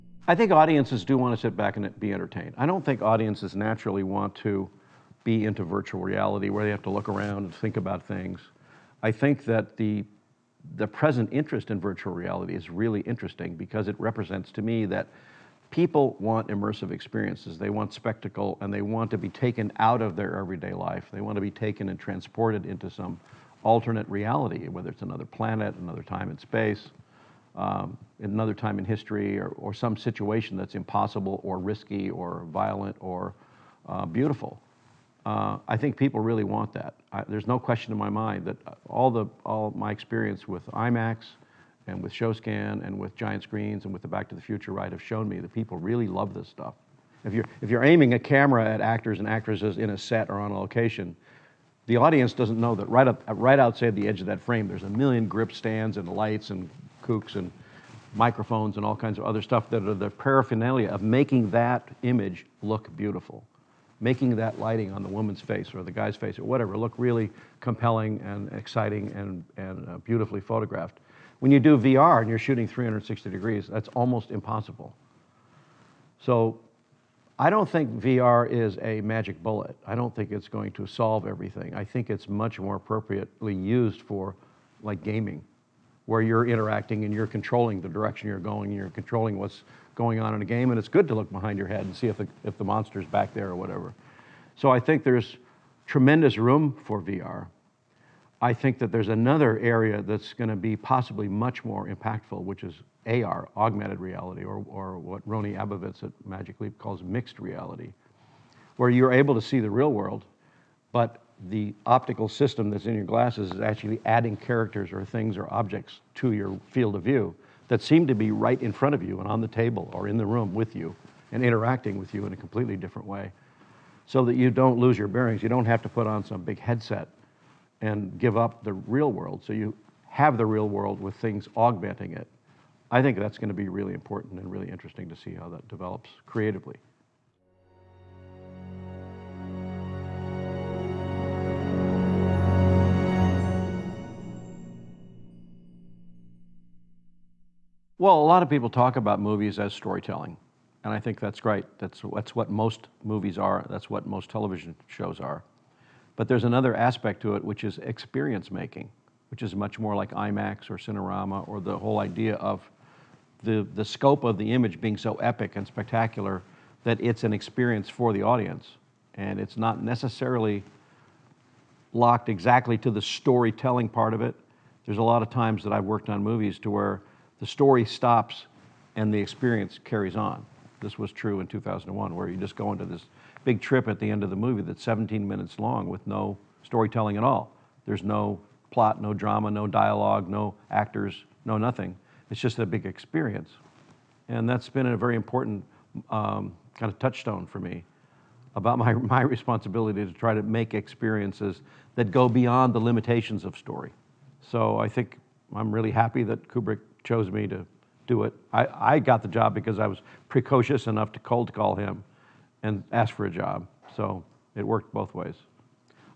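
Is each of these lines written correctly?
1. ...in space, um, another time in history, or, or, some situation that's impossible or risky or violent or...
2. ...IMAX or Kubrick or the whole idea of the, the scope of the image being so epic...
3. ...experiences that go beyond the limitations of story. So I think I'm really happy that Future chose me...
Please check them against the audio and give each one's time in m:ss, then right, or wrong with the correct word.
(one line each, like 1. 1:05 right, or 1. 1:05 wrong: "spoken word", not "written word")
1. 0:26 right
2. 2:40 wrong: "Cinerama", not "Kubrick"
3. 3:20 wrong: "Kubrick", not "Future".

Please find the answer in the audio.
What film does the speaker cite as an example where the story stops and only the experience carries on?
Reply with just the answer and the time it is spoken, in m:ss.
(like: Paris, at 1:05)
2001, at 3:01.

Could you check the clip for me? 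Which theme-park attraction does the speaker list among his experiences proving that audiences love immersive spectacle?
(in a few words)
Back to the Future ride.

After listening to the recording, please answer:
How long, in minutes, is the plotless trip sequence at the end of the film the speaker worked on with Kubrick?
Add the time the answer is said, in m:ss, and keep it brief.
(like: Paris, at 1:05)
17, at 3:04.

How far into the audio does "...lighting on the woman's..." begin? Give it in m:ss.
1:04.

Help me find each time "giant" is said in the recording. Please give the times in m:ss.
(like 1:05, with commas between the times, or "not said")
0:43.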